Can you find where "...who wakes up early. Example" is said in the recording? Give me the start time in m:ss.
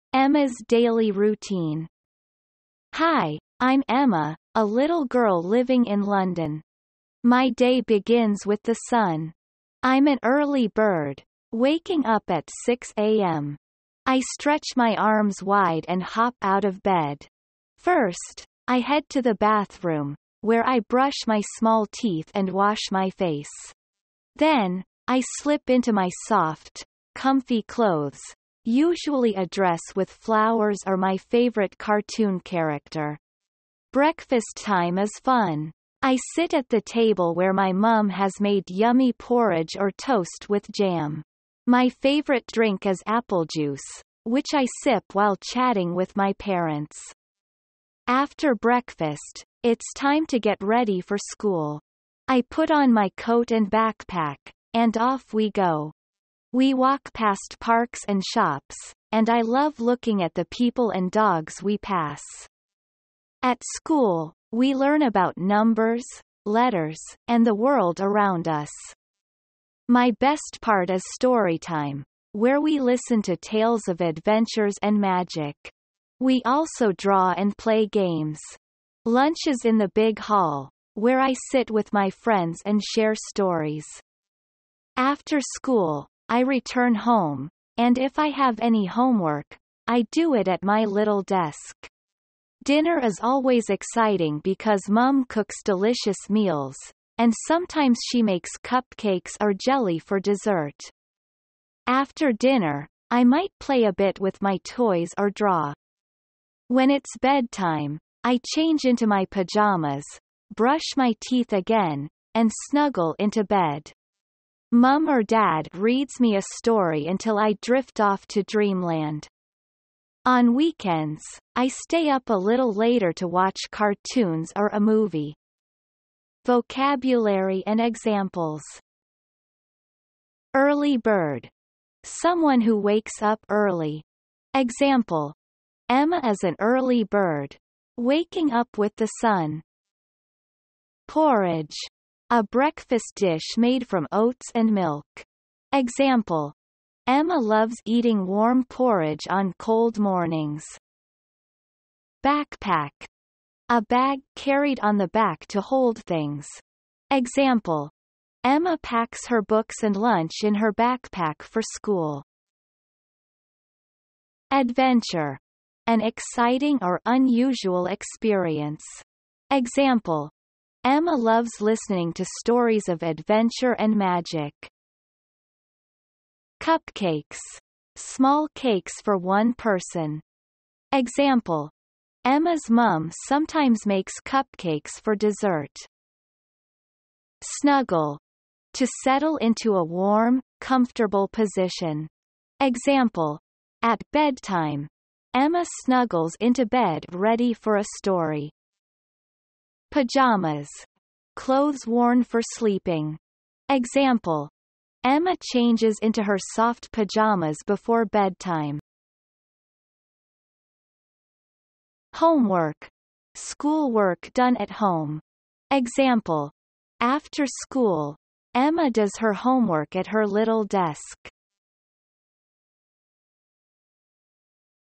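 2:12.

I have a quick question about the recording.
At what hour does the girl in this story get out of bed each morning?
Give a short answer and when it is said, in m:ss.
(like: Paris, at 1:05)
6 a.m., at 0:12.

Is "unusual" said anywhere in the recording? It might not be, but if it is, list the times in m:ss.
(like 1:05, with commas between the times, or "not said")
2:47.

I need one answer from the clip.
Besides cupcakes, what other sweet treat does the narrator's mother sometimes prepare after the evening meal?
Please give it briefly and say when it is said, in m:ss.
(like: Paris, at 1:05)
Jelly, at 1:39.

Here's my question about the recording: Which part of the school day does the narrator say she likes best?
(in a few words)
Story time.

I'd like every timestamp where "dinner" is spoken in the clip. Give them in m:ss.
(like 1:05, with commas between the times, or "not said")
1:32, 1:42.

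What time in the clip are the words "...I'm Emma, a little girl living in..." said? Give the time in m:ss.
0:03.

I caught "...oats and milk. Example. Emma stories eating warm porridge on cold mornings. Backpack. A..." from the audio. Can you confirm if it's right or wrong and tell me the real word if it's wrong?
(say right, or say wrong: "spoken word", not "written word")
wrong: "loves", not "stories".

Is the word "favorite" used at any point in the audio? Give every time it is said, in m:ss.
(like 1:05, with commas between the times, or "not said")
0:31, 0:41.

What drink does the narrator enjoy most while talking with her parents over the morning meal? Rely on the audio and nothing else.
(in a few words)
Apple juice.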